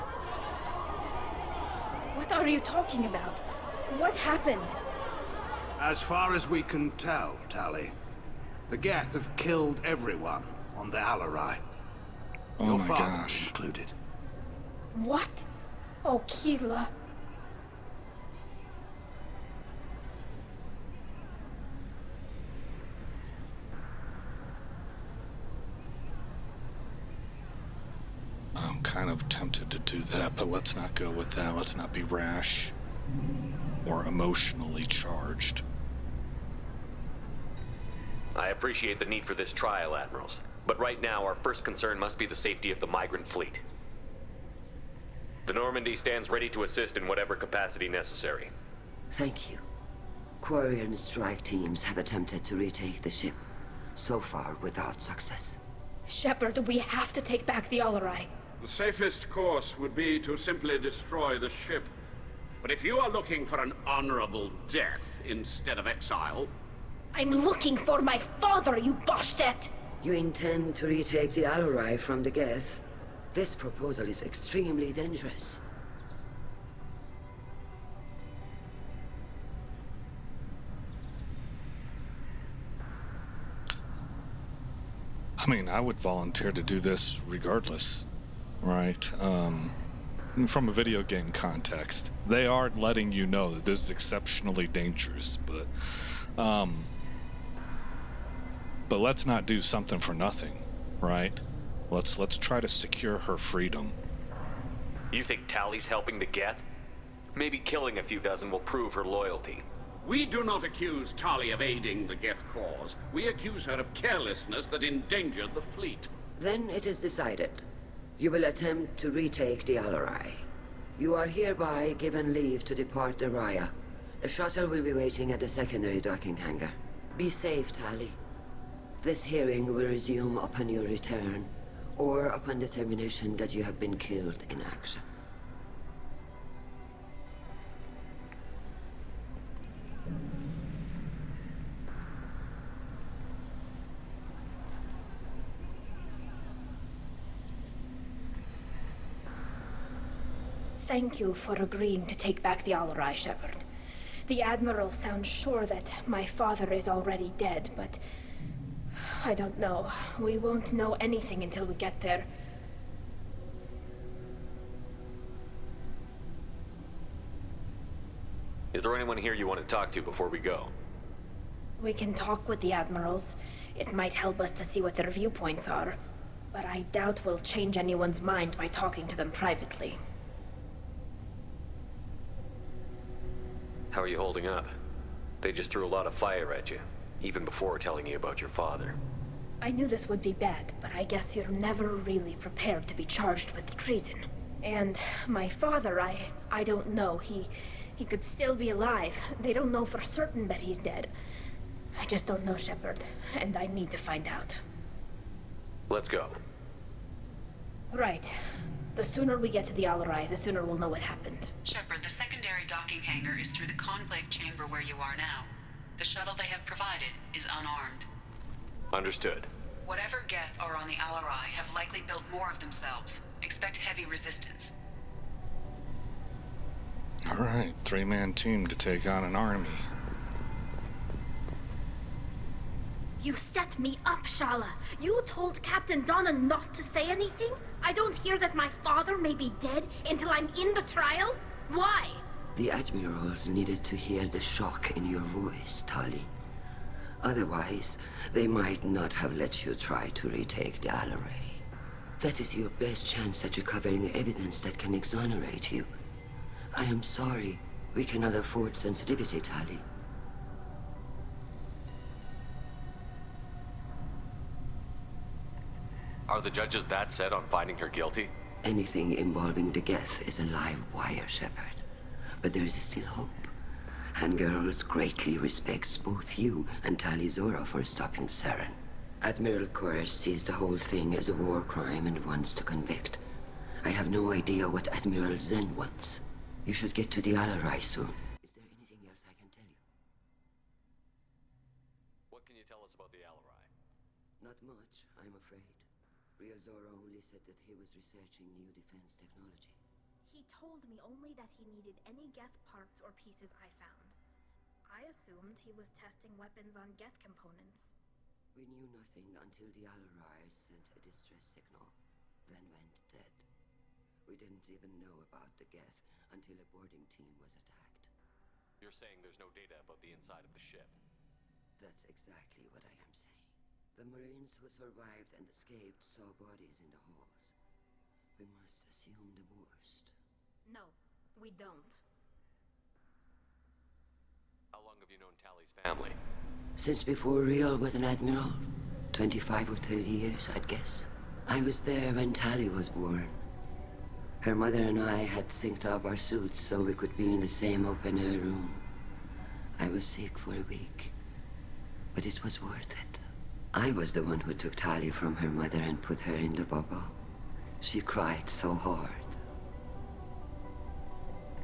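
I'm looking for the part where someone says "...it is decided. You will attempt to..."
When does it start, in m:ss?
1:56.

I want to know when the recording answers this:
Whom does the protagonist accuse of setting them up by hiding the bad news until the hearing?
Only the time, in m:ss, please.
3:54.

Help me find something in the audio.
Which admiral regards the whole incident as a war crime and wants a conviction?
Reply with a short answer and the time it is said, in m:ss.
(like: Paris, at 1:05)
Admiral Koris, at 4:39.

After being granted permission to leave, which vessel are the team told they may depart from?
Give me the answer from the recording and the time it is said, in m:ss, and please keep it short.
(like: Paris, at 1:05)
Rayya, at 2:03.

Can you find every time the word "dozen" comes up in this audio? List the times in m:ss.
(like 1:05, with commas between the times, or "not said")
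1:48.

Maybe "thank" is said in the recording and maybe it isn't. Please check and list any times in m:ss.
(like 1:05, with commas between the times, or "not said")
0:49, 2:30.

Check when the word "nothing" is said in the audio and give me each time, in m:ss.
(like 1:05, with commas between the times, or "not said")
1:40, 5:08.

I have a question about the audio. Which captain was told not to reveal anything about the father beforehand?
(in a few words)
Captain Danna.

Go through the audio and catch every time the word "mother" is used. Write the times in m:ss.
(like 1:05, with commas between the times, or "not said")
5:44, 5:55.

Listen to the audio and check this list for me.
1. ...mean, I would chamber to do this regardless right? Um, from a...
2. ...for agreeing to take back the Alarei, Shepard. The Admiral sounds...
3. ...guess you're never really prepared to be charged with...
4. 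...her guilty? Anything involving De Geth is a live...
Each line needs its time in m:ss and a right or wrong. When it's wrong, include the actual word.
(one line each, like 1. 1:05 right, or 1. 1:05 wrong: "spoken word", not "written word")
1. 1:25 wrong: "volunteer", not "chamber"
2. 2:31 right
3. 3:11 right
4. 4:27 right.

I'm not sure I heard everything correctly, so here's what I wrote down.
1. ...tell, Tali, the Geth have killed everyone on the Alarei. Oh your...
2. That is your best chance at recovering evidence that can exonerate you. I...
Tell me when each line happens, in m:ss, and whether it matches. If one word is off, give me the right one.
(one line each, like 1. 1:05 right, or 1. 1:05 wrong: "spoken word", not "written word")
1. 0:06 right
2. 4:12 right.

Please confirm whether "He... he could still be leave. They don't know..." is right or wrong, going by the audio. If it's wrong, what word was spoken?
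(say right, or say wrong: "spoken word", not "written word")
wrong: "alive", not "leave".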